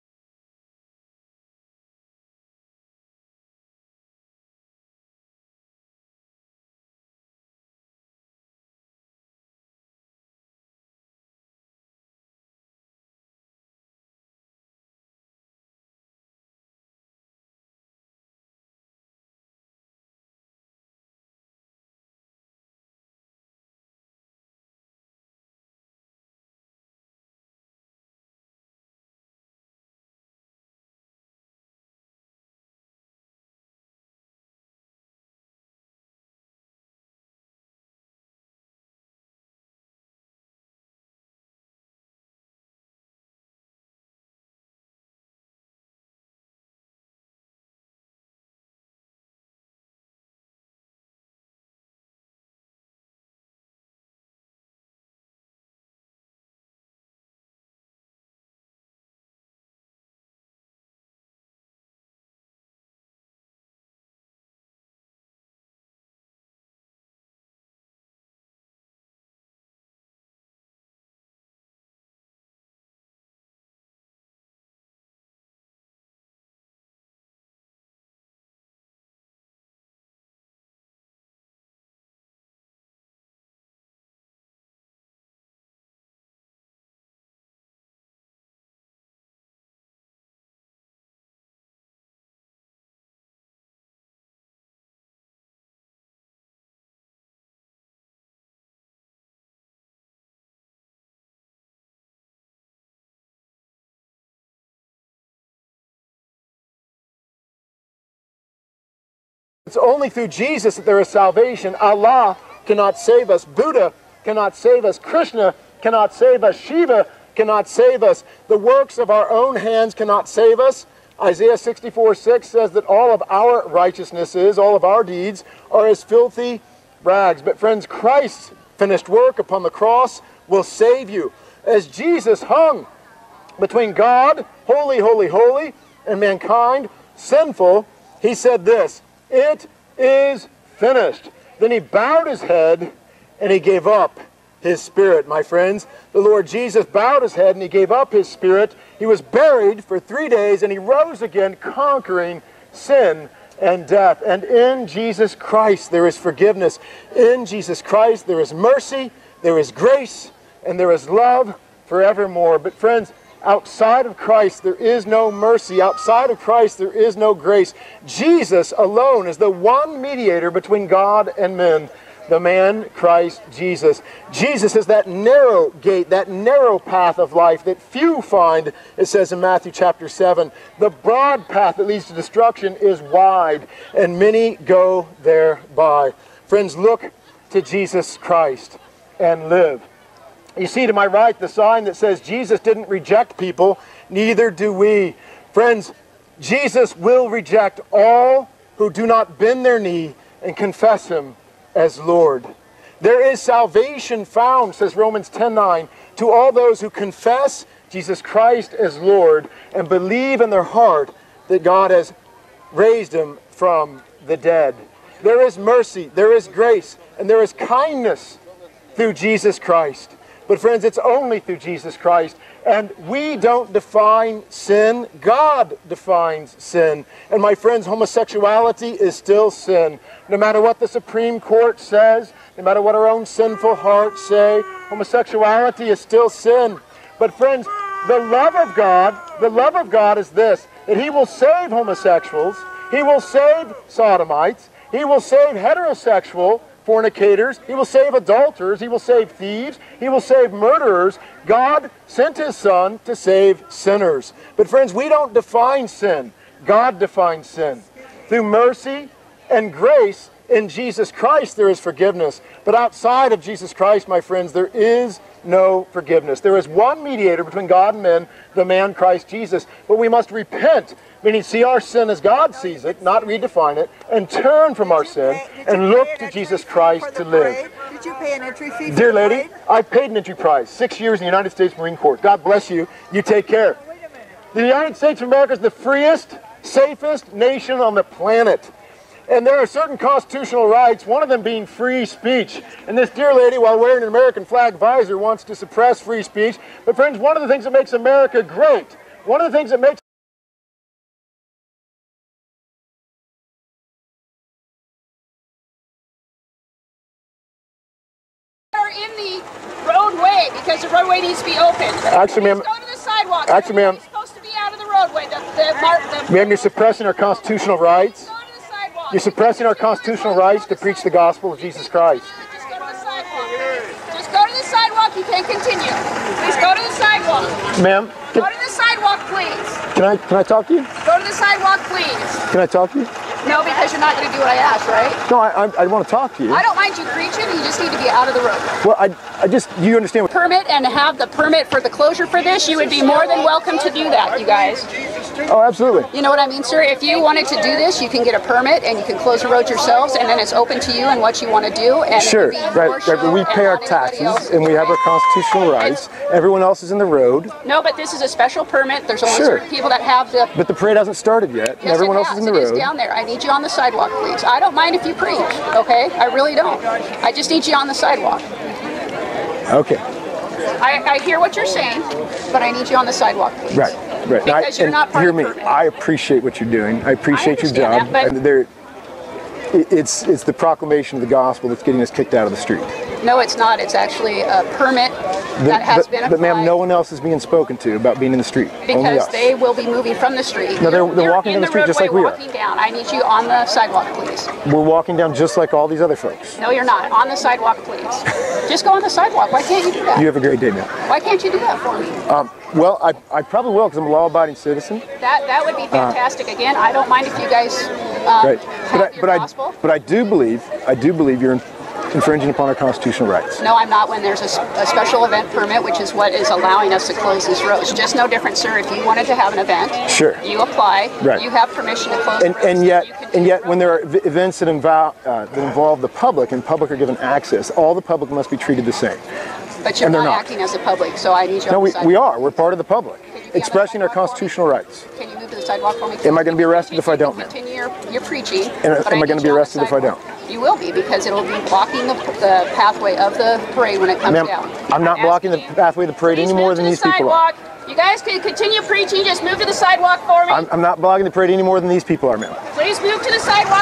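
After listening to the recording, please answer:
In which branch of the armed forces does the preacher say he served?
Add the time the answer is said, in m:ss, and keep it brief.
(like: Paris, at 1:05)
United States Marine Corps, at 4:41.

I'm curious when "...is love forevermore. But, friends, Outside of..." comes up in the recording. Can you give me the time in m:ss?
2:40.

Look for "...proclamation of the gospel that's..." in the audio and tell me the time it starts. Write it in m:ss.
6:20.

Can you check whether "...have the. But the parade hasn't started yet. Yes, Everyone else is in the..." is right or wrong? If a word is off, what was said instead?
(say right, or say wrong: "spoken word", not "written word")
right.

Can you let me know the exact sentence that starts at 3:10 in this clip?
You see to my right the sign that says Jesus didn't reject people, neither do we.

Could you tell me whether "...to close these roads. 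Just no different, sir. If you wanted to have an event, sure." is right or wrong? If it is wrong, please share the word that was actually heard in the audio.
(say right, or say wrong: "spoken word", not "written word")
right.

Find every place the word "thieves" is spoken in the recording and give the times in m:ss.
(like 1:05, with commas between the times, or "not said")
4:09.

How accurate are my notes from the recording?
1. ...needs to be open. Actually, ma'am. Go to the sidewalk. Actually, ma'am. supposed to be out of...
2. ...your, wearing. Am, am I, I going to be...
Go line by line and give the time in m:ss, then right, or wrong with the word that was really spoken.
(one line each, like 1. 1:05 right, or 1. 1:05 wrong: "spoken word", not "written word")
1. 5:11 right
2. 7:17 wrong: "preaching", not "wearing".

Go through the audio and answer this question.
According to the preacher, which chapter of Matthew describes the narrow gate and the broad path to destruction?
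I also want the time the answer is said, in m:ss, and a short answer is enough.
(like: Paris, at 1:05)
Matthew chapter 7, at 2:59.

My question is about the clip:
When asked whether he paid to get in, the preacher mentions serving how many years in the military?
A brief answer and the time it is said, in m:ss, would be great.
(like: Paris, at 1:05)
6, at 4:40.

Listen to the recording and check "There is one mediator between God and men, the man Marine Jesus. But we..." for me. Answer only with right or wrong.
wrong.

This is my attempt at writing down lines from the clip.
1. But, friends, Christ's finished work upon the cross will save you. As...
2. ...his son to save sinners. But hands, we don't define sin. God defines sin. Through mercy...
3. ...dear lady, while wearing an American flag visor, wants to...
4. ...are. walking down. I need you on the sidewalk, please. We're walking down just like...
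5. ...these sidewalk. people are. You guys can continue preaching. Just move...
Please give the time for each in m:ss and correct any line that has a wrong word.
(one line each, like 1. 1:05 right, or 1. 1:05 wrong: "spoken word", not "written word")
1. 2:07 right
2. 4:12 wrong: "friends", not "hands"
3. 4:53 right
4. 6:32 right
5. 7:26 right.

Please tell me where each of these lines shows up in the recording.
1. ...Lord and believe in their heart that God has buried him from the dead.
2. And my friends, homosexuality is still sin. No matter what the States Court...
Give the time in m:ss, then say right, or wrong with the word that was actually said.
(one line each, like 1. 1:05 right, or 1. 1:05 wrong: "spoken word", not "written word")
1. 3:28 wrong: "raised", not "buried"
2. 3:47 wrong: "Supreme", not "States".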